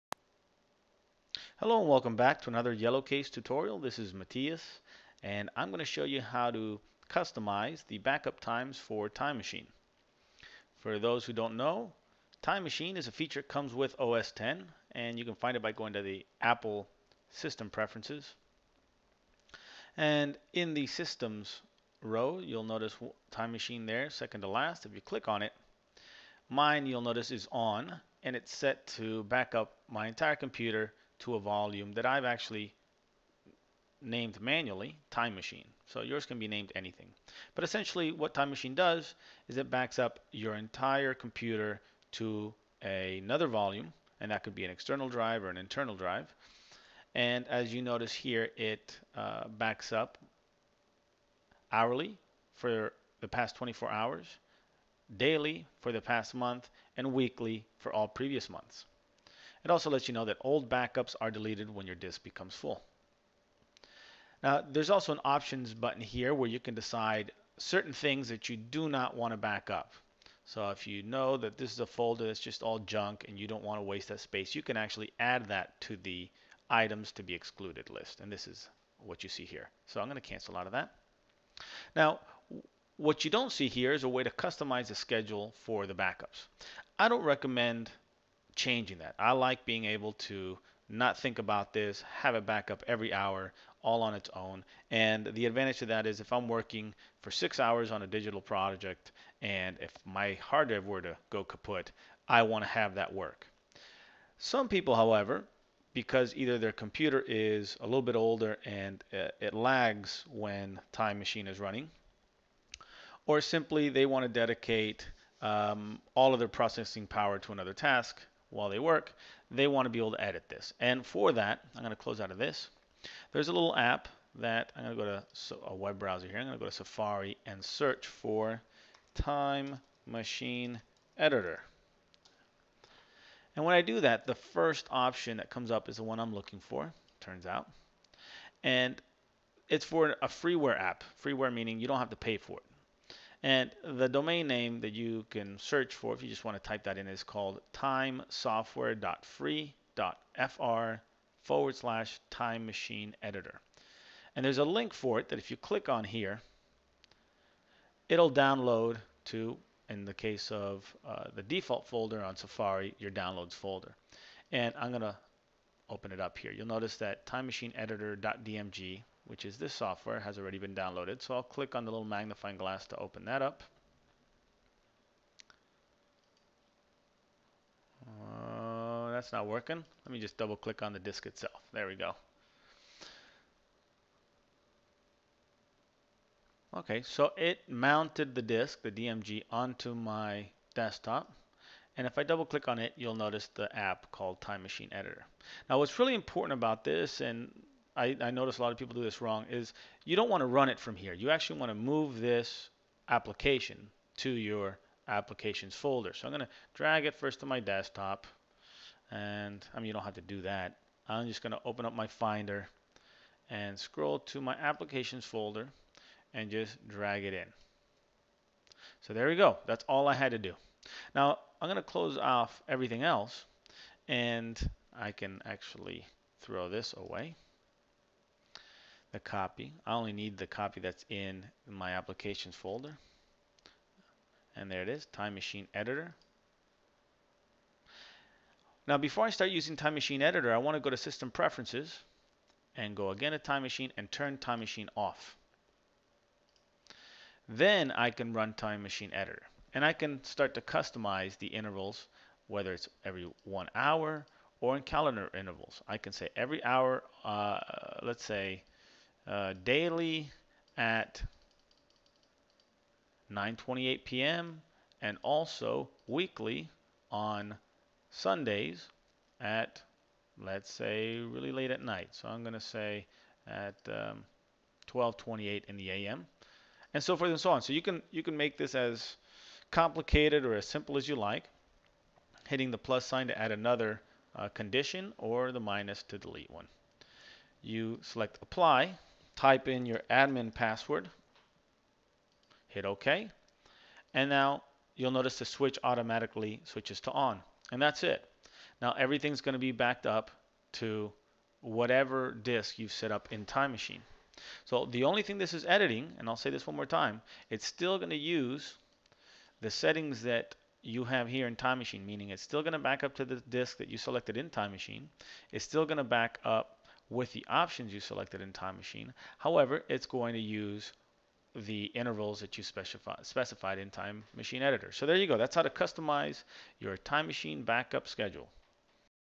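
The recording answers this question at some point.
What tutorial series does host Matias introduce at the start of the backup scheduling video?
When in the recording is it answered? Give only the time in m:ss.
0:02.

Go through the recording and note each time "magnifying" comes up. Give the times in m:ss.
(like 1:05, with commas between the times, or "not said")
2:52.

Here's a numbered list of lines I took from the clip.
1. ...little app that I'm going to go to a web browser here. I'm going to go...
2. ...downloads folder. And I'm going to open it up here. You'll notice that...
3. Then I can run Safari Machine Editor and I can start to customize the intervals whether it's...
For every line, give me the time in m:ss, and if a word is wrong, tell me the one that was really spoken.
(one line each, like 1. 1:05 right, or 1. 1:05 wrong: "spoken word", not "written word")
1. 2:03 right
2. 2:43 right
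3. 4:07 wrong: "Time", not "Safari".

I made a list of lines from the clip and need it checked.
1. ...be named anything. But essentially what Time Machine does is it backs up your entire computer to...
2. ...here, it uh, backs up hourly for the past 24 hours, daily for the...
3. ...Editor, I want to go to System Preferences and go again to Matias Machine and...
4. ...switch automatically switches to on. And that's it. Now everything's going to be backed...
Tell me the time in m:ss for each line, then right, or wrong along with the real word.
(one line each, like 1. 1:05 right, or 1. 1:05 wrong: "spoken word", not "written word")
1. 0:36 right
2. 0:48 right
3. 4:00 wrong: "Time", not "Matias"
4. 4:55 right.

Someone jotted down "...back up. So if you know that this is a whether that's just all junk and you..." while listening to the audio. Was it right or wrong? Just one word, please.
wrong.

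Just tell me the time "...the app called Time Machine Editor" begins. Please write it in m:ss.
3:13.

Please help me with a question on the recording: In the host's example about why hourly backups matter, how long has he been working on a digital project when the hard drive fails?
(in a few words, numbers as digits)
6 hours.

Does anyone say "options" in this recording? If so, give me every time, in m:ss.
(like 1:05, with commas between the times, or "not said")
1:05, 2:14, 5:17.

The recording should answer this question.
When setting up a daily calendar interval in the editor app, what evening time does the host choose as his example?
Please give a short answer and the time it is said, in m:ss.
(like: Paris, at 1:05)
9:28 p.m., at 4:23.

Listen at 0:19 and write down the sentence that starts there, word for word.
And in the Systems row, you'll notice Time Machine there, second to last.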